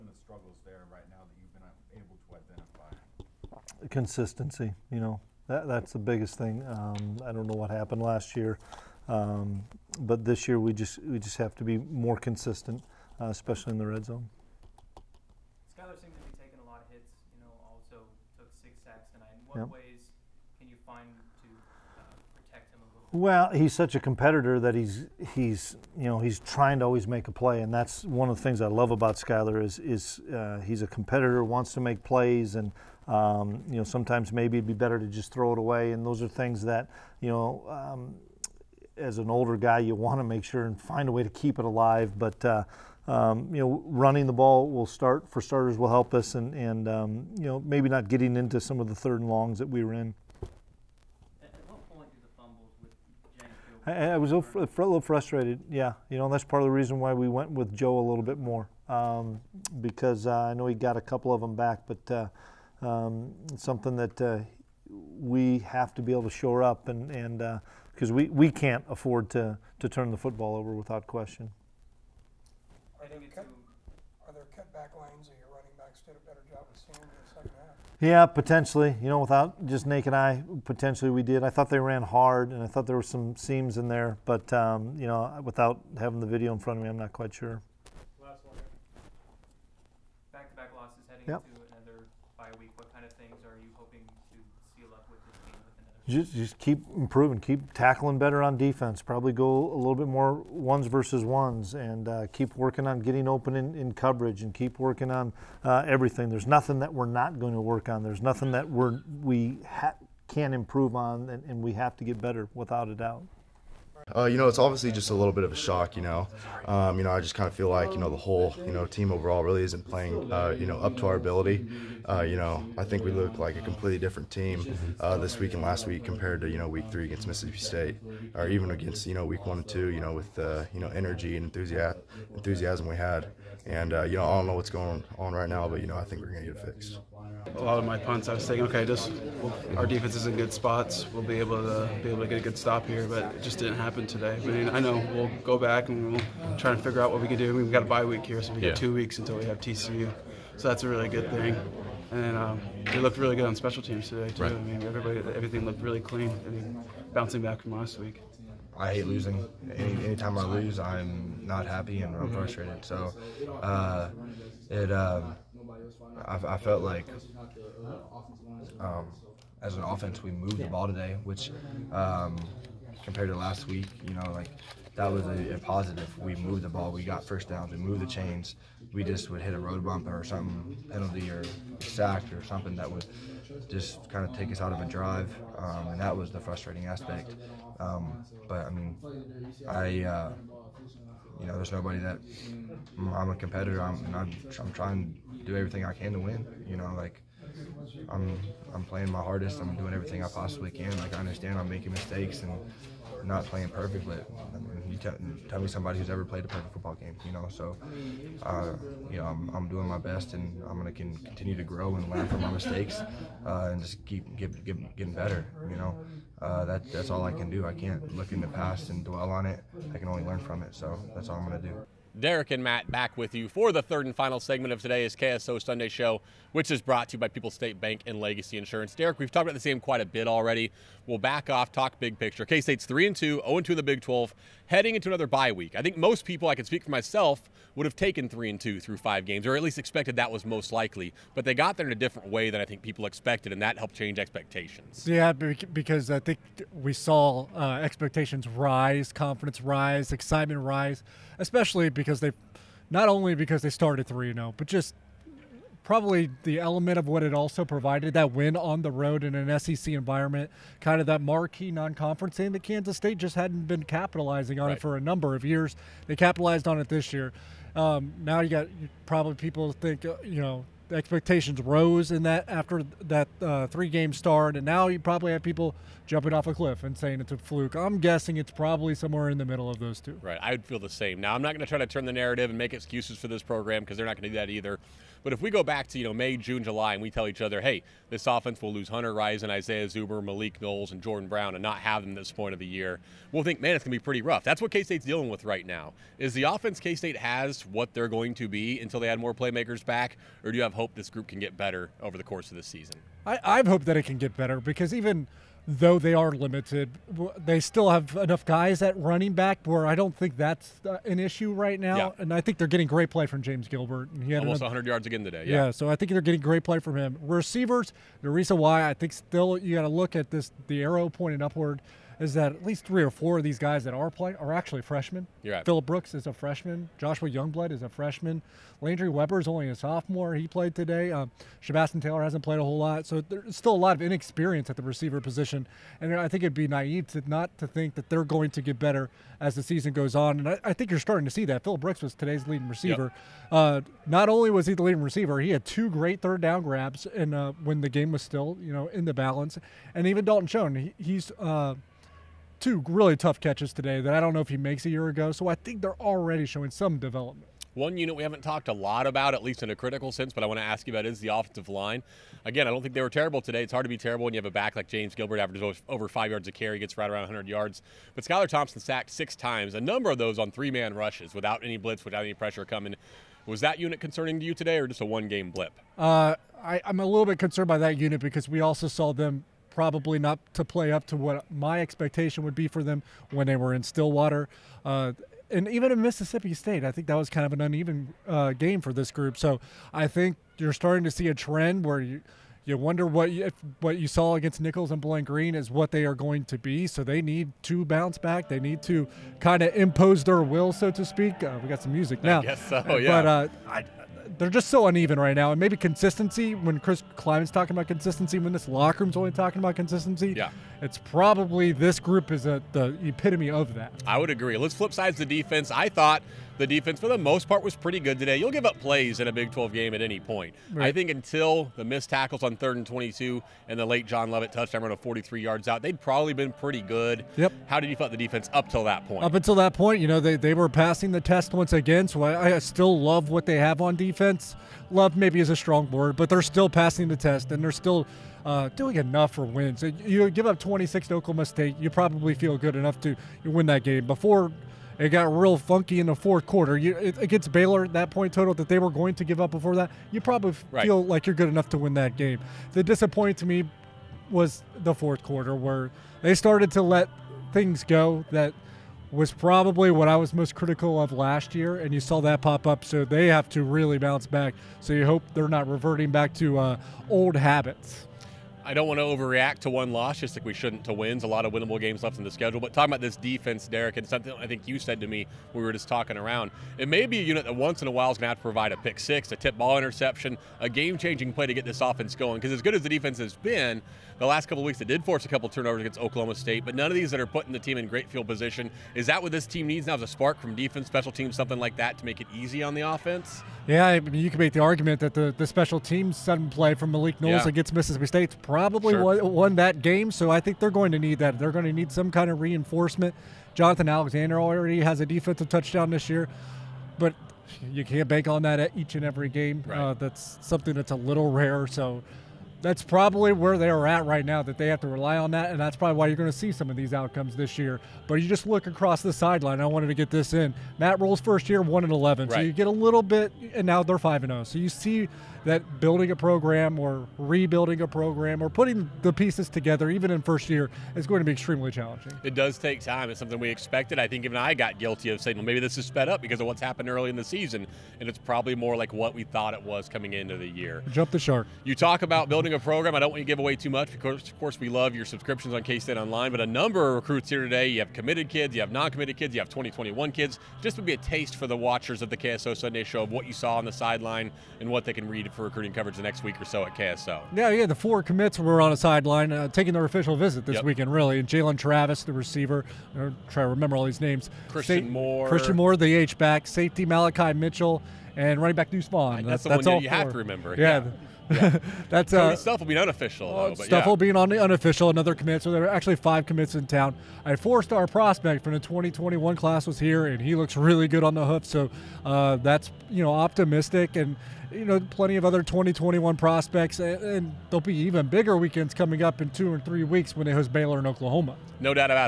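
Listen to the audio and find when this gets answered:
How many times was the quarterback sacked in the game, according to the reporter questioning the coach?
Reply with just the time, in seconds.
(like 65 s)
18 s.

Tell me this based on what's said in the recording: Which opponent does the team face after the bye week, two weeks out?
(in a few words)
TCU.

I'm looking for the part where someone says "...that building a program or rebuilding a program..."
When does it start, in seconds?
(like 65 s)
525 s.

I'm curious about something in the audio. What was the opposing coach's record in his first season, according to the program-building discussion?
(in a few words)
1 and 11.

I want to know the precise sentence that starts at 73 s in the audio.
Are there, cut, are there lanes your running backs did a better job of seeing in the second half?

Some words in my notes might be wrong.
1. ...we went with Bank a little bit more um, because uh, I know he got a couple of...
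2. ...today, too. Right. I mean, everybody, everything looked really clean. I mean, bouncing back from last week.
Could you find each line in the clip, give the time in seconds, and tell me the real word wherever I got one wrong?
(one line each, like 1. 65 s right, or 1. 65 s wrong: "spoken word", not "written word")
1. 57 s wrong: "Joe", not "Bank"
2. 154 s right.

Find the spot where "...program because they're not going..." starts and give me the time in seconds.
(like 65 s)
283 s.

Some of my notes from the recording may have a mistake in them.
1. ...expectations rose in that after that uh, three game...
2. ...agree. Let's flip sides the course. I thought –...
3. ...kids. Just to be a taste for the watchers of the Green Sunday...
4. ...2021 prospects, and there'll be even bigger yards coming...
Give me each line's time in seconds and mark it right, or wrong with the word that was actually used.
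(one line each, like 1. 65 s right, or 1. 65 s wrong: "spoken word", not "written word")
1. 270 s right
2. 414 s wrong: "defense", not "course"
3. 550 s wrong: "KSO", not "Green"
4. 585 s wrong: "weekends", not "yards".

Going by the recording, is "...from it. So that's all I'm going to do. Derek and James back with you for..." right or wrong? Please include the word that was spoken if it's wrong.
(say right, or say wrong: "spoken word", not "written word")
wrong: "Matt", not "James".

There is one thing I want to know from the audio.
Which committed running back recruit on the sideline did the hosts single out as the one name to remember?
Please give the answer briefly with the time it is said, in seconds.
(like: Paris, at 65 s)
Deuce Vaughn, at 568 s.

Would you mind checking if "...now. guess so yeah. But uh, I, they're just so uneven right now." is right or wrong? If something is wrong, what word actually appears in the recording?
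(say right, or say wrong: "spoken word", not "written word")
right.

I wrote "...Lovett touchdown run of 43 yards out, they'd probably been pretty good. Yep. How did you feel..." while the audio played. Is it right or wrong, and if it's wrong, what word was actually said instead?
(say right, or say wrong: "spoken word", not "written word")
right.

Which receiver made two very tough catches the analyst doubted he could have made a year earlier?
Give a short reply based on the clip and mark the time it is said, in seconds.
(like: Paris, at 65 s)
Dalton Schoen, at 350 s.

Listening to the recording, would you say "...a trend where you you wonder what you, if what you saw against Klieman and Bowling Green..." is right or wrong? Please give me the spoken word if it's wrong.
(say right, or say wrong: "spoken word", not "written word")
wrong: "Nicholls", not "Klieman".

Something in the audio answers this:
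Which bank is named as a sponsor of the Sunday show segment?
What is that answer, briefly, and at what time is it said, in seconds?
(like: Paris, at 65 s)
People's State Bank, at 227 s.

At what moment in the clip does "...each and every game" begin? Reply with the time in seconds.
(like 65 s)
508 s.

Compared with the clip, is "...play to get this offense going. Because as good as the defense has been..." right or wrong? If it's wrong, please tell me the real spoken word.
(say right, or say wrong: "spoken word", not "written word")
right.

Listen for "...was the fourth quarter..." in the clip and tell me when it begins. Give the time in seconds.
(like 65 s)
454 s.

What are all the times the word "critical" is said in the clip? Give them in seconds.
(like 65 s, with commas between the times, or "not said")
359 s, 460 s.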